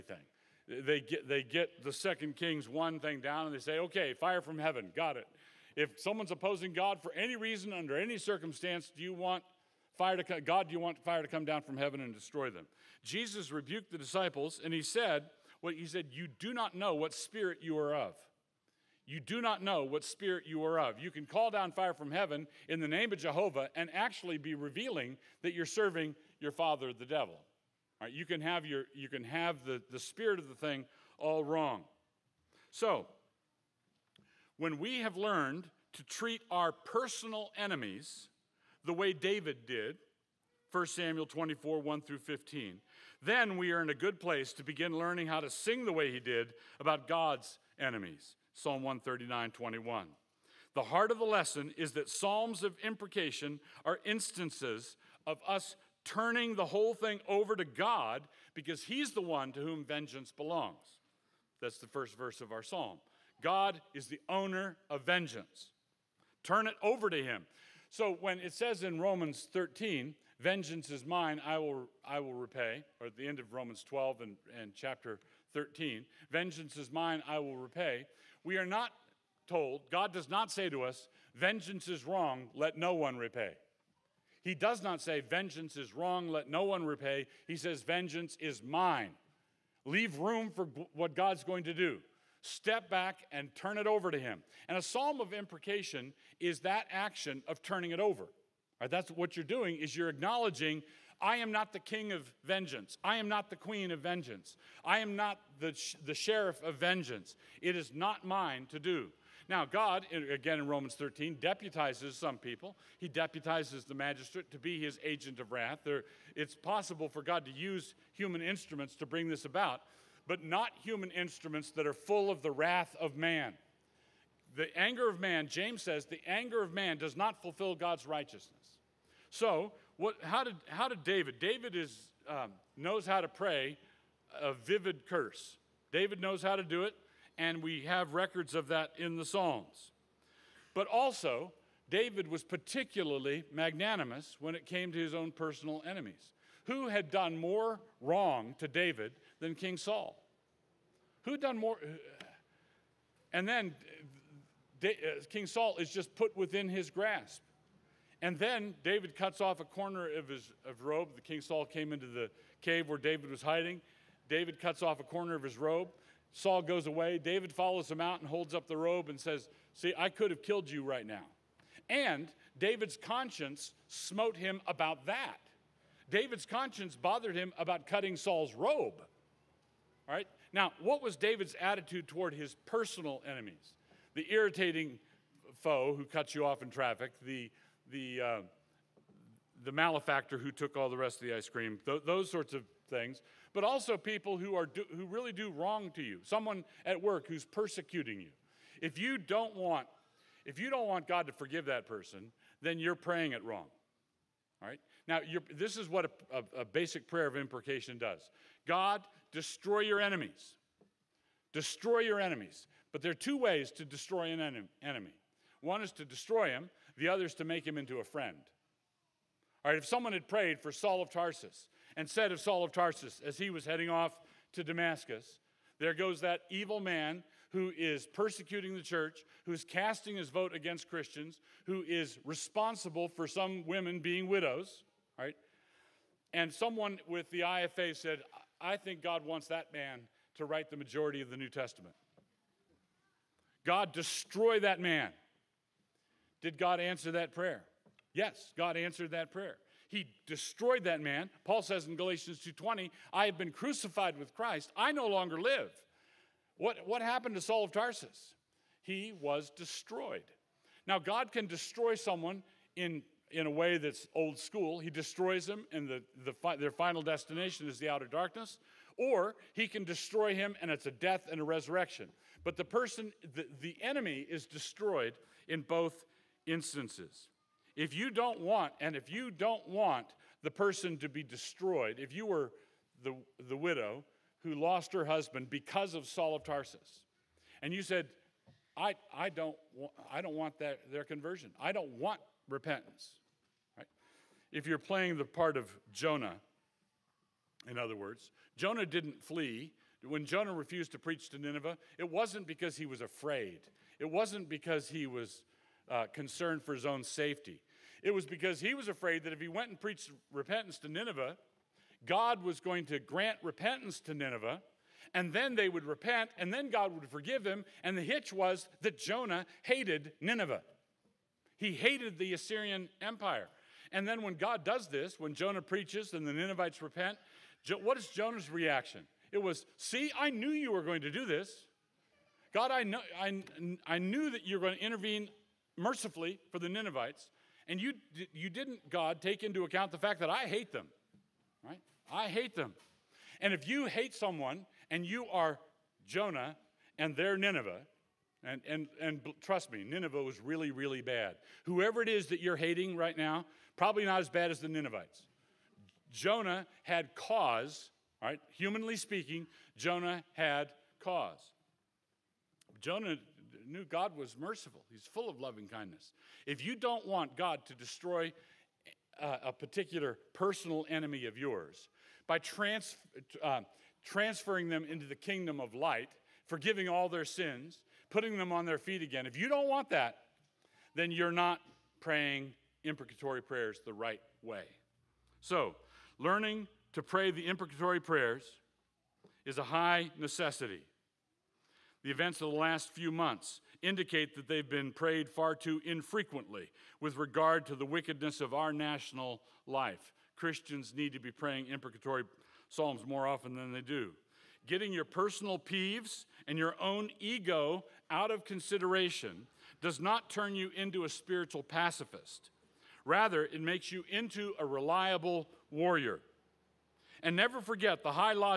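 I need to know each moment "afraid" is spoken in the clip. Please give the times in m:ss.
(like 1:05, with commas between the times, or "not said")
5:03, 5:08.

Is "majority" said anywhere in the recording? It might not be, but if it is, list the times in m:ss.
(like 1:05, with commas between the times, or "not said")
4:00.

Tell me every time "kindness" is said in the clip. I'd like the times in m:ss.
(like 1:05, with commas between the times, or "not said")
6:05.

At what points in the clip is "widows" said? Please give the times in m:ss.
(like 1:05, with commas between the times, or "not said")
3:54, 4:43.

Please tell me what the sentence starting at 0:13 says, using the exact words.
Jesus rebuked the disciples and he said, what well, he said, you do not know what spirit you are of.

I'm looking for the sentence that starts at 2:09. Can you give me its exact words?
So, what, how, did, how did David?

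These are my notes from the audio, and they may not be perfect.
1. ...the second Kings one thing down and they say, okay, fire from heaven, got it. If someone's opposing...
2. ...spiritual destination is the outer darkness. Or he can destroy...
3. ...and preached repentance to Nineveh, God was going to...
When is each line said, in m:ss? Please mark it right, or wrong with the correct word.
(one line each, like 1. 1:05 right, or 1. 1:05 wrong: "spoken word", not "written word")
1. 0:01 right
2. 4:26 wrong: "final", not "spiritual"
3. 5:09 right.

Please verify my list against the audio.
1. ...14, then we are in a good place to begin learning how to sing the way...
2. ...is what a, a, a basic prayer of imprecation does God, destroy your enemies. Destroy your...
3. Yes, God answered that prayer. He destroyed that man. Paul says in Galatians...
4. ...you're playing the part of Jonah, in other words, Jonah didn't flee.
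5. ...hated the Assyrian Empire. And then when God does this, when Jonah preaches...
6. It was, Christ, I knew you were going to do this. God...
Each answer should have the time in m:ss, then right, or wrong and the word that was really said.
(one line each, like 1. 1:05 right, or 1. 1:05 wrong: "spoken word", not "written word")
1. 0:42 wrong: "15", not "14"
2. 3:25 right
3. 4:08 right
4. 4:54 right
5. 5:21 right
6. 5:29 wrong: "See", not "Christ".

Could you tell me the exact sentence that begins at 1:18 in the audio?
We are not told, God does not say to us, Vengeance is wrong, let no one repay.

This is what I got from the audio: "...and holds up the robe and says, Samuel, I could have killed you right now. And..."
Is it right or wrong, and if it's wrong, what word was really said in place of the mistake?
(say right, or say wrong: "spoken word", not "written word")
wrong: "See", not "Samuel".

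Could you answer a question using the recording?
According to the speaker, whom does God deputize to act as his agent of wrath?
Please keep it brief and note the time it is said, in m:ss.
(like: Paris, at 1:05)
The magistrate, at 1:53.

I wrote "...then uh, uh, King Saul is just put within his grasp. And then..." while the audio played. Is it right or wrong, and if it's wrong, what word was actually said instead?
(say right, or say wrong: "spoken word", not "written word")
right.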